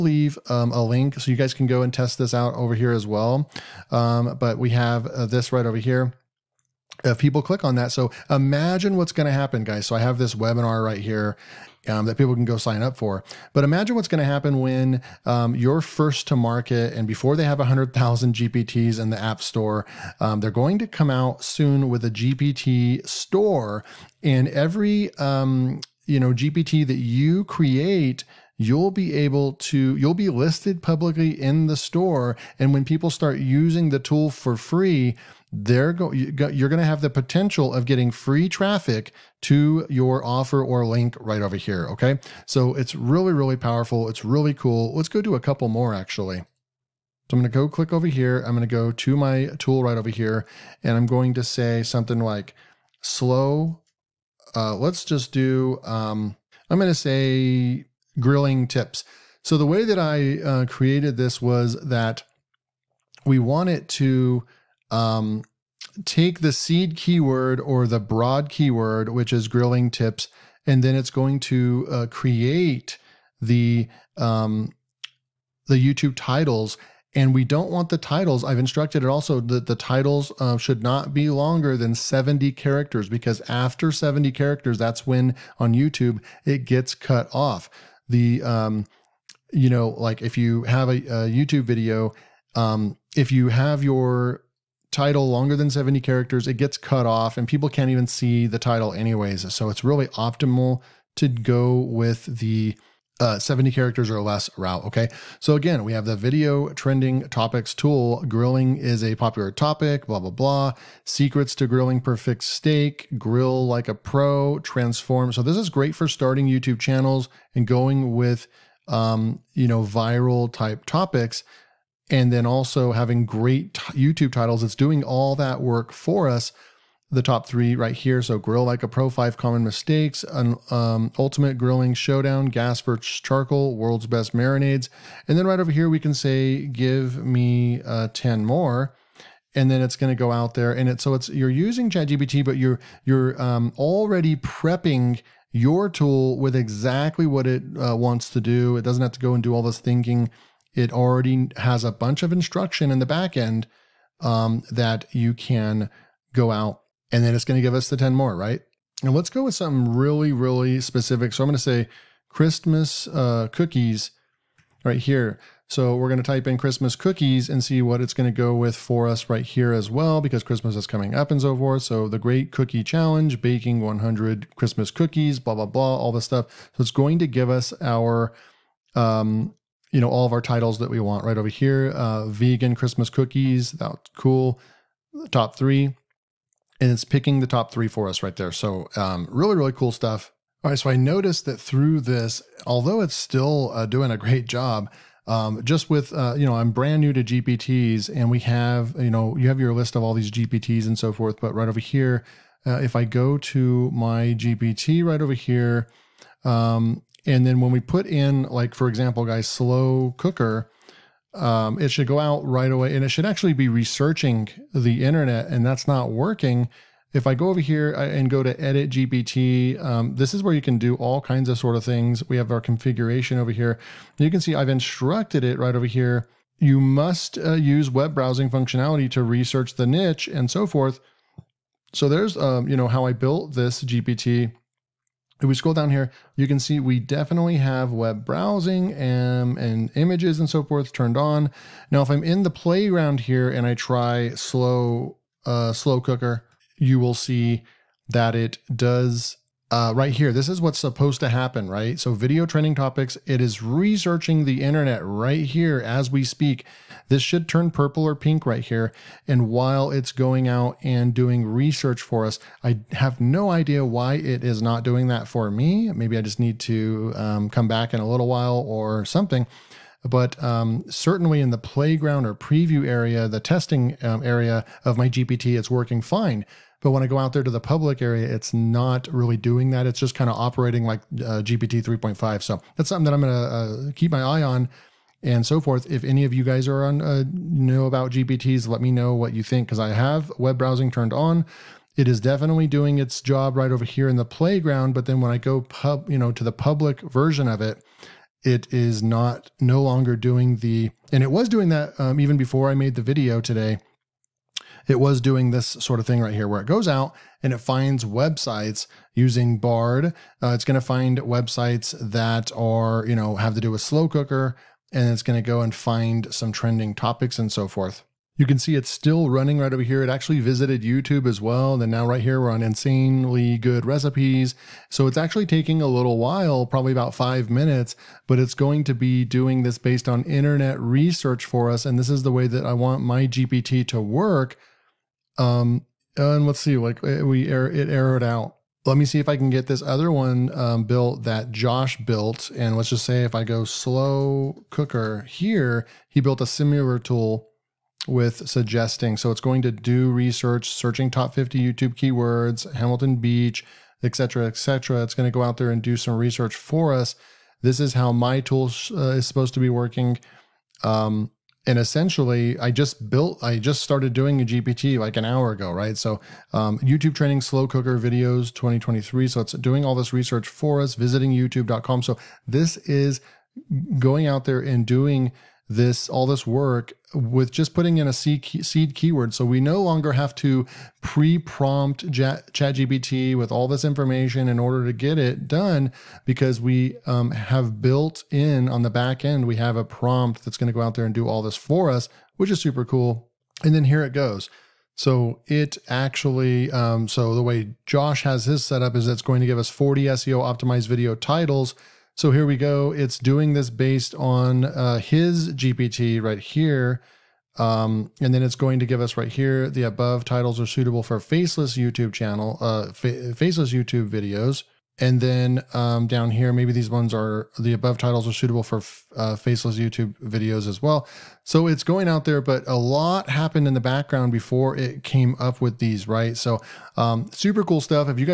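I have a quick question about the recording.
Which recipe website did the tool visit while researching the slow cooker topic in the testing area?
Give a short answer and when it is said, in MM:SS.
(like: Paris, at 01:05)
Insanely Good Recipes, at 05:22.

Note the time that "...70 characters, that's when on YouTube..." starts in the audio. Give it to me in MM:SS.
01:23.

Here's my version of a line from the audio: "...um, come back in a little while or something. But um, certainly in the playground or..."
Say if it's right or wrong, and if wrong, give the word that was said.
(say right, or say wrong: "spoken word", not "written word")
right.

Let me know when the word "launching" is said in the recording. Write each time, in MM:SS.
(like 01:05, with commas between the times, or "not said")
not said.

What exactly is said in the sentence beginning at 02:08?
So grill like a pro, five common mistakes, an, um, ultimate grilling showdown, gas versus charcoal, world's best marinades.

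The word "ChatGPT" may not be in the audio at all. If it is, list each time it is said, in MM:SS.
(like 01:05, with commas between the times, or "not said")
02:21, 06:22.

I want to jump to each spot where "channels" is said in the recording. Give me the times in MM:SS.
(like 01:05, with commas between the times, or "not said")
01:56, 06:52.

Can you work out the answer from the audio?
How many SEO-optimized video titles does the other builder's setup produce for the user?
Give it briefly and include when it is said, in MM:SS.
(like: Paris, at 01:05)
40, at 06:39.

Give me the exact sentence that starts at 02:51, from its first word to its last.
So the Great Cookie Challenge, baking 100 Christmas cookies, blah, blah, blah, all this stuff.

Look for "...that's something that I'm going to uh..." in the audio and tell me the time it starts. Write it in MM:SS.
04:42.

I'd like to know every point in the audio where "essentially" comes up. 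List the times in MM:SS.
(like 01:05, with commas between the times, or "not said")
06:01.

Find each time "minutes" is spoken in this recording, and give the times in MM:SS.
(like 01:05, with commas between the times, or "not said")
05:27.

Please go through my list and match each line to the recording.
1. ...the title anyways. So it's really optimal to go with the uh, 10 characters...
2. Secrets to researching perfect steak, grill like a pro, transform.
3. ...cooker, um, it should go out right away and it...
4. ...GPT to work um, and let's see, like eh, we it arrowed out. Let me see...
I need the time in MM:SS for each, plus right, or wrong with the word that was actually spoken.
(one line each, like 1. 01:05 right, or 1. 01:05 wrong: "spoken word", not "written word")
1. 01:38 wrong: "70", not "10"
2. 01:51 wrong: "grilling", not "researching"
3. 03:30 right
4. 05:33 right.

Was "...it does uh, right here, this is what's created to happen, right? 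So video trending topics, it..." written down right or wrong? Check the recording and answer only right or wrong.
wrong.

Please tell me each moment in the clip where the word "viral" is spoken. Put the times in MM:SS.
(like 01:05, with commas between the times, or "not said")
01:59.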